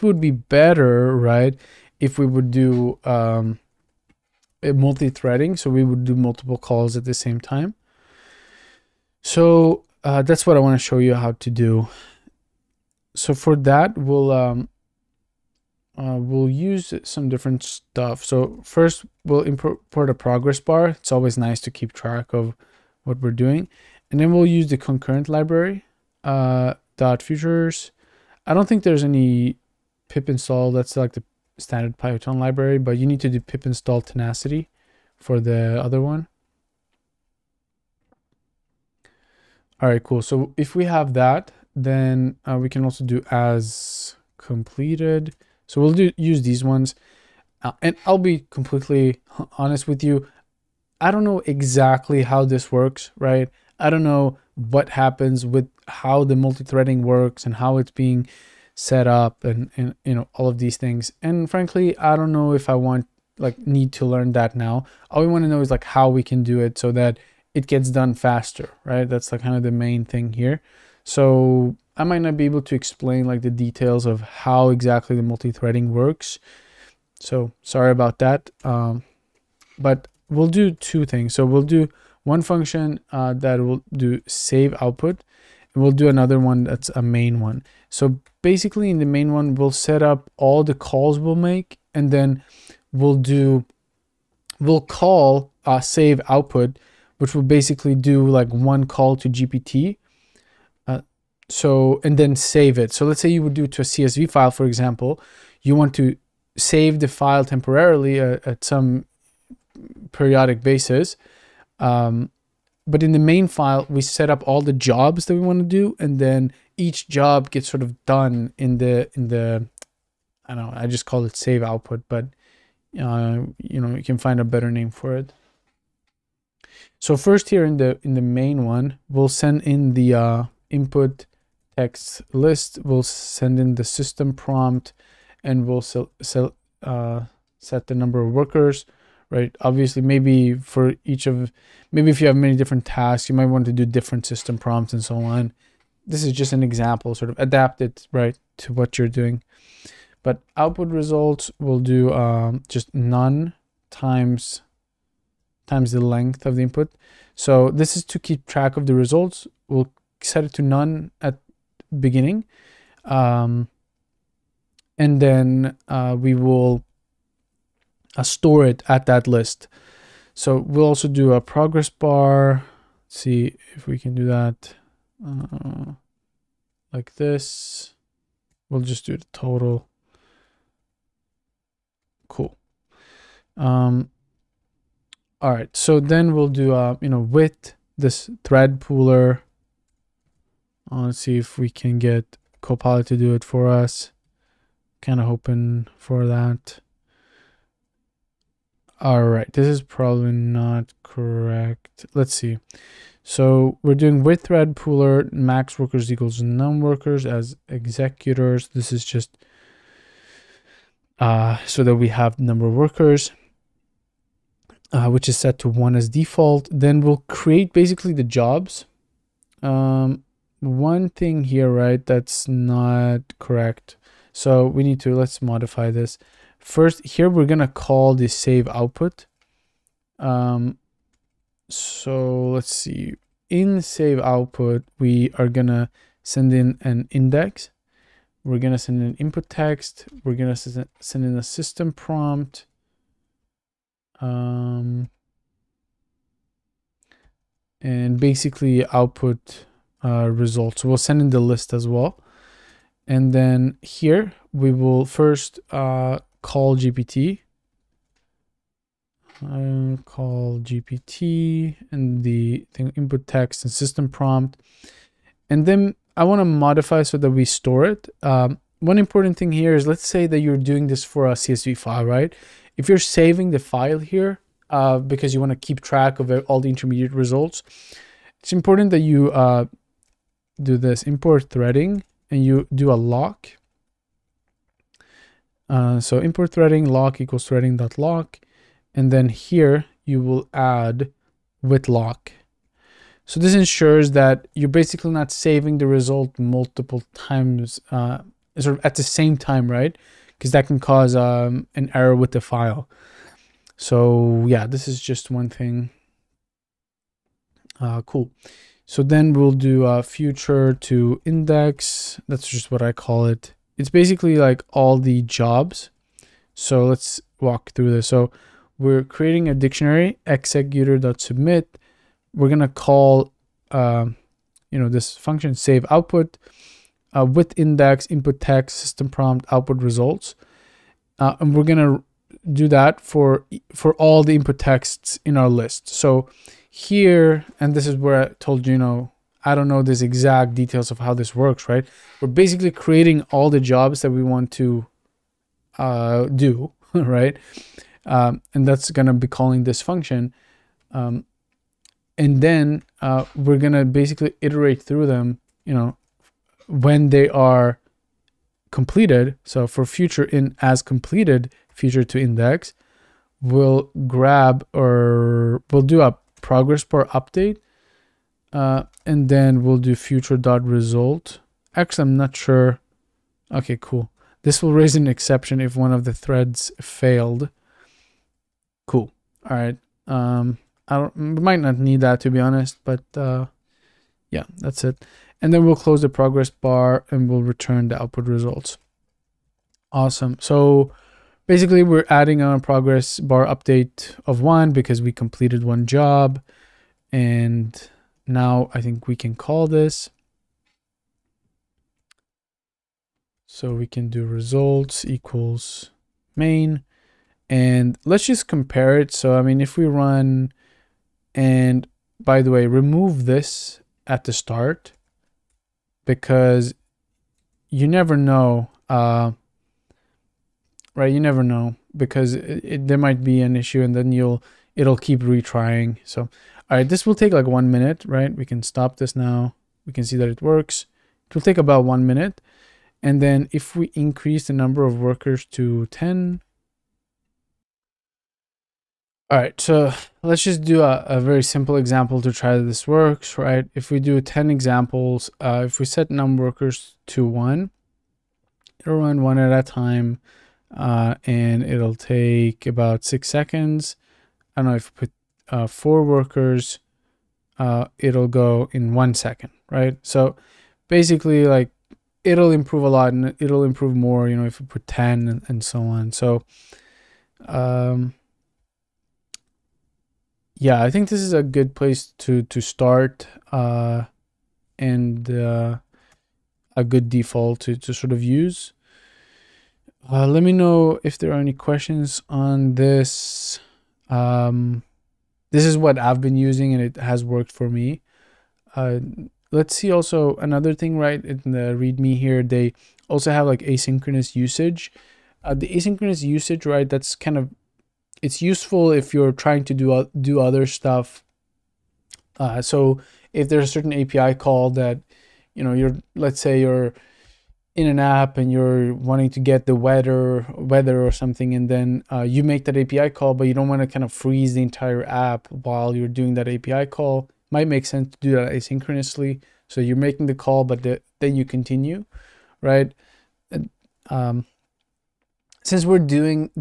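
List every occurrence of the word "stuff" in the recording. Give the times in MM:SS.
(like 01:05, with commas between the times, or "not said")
00:17, 08:20.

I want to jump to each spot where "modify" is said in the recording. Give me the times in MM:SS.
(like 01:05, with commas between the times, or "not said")
03:45, 04:26.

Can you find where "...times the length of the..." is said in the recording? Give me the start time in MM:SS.
02:35.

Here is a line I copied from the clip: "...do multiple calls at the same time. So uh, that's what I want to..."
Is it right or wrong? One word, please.
right.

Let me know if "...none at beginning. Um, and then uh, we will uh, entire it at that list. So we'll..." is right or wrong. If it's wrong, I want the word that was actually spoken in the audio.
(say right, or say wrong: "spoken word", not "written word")
wrong: "store", not "entire".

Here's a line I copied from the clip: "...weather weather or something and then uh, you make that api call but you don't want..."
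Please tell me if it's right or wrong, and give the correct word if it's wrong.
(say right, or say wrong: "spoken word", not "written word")
right.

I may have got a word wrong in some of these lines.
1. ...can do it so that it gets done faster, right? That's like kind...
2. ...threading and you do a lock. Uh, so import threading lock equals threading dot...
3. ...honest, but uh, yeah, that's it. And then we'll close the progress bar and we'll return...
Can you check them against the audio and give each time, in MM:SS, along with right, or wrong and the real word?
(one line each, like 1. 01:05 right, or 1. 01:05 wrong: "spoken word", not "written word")
1. 01:06 right
2. 04:41 right
3. 06:22 right.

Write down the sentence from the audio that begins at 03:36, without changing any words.
Then we'll create basically the jobs.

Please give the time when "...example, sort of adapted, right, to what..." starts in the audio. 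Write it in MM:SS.
02:26.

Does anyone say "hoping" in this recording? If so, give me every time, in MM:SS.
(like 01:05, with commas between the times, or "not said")
03:15.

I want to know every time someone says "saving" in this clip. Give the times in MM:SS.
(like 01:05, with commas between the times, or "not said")
04:32, 04:55.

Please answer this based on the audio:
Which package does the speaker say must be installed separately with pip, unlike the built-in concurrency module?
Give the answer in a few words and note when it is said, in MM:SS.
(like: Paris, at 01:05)
tenacity, at 00:34.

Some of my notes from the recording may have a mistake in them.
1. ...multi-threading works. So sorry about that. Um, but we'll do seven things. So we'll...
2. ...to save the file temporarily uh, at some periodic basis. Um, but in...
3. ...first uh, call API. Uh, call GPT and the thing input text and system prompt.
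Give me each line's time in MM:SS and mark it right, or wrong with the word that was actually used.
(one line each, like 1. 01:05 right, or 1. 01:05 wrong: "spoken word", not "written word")
1. 01:15 wrong: "two", not "seven"
2. 01:45 right
3. 04:15 wrong: "GPT", not "API".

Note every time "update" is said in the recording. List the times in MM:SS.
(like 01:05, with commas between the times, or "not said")
06:07, 06:33.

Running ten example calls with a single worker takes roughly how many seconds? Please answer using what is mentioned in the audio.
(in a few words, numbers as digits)
6.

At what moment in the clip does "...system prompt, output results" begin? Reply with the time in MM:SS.
05:28.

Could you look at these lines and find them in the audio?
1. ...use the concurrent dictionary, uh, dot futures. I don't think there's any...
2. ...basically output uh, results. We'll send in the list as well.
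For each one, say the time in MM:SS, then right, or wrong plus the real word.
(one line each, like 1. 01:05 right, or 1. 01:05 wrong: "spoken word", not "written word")
1. 00:24 wrong: "library", not "dictionary"
2. 04:08 right.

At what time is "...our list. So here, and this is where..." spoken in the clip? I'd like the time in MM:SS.
05:35.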